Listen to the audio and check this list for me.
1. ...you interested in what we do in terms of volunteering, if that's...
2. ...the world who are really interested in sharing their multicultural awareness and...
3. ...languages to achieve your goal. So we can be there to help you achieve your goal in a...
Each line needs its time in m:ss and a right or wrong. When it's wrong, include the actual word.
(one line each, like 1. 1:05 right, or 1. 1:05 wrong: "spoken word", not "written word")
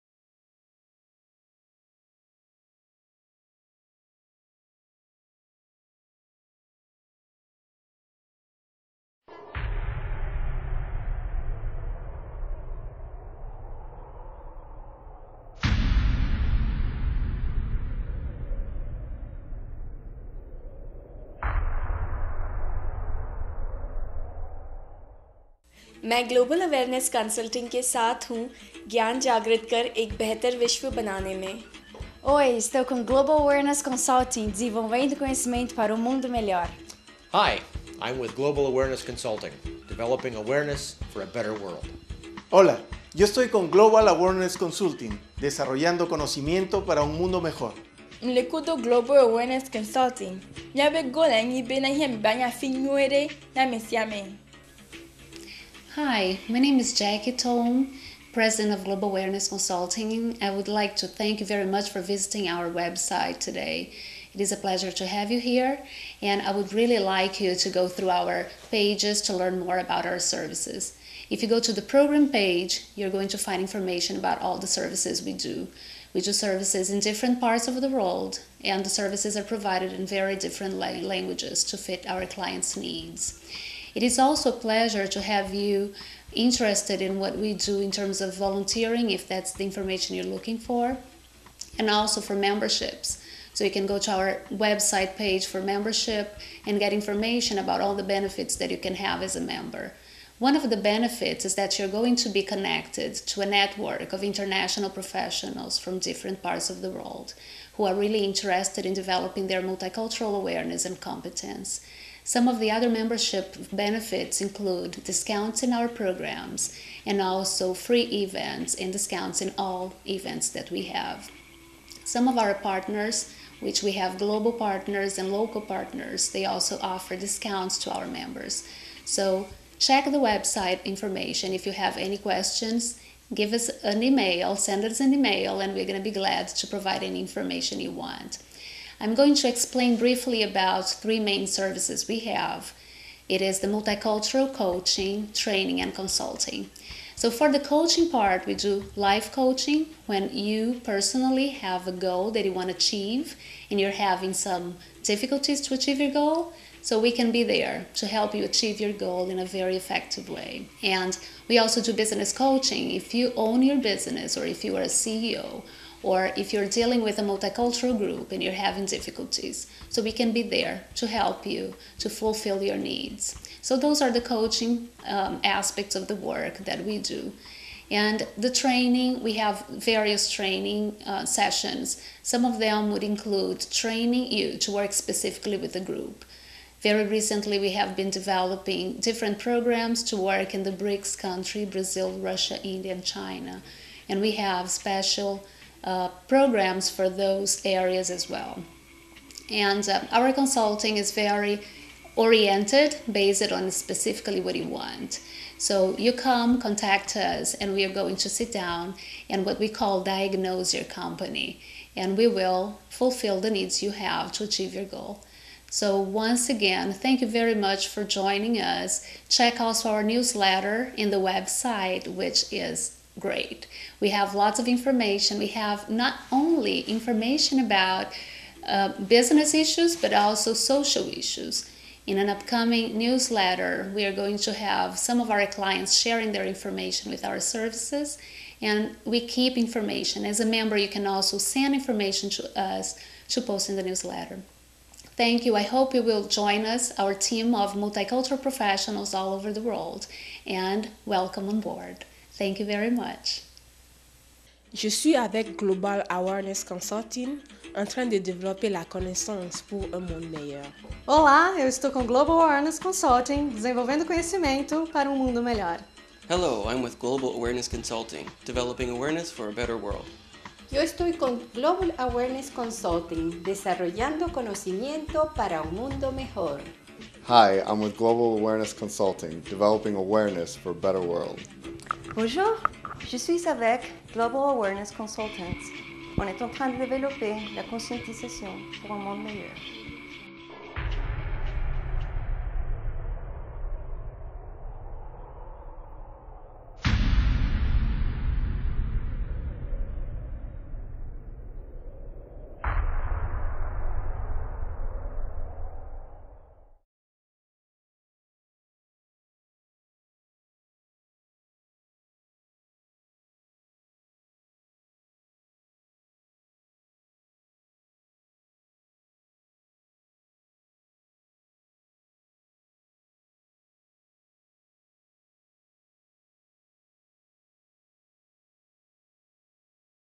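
1. 1:25 right
2. 1:46 wrong: "developing", not "sharing"
3. 2:35 wrong: "difficulties", not "languages".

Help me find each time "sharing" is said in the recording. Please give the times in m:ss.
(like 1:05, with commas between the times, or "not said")
3:55.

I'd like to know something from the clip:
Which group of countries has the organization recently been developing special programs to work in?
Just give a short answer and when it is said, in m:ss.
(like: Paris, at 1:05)
BRICS, at 3:10.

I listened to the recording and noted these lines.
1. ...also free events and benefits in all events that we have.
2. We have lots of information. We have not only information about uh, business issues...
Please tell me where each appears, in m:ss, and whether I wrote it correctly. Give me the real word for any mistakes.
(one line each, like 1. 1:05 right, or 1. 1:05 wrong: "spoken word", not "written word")
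1. 1:57 wrong: "discounts", not "benefits"
2. 3:44 right.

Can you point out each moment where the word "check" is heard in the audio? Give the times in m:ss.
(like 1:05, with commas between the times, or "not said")
2:09, 3:39.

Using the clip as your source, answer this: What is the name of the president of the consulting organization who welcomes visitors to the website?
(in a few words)
Jackie Tom.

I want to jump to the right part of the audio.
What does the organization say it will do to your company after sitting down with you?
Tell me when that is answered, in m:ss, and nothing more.
3:30.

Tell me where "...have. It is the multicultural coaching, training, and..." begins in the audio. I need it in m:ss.
2:22.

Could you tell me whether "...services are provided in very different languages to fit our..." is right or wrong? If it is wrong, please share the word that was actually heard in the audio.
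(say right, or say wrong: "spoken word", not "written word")
right.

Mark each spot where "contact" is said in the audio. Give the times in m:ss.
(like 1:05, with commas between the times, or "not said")
3:26.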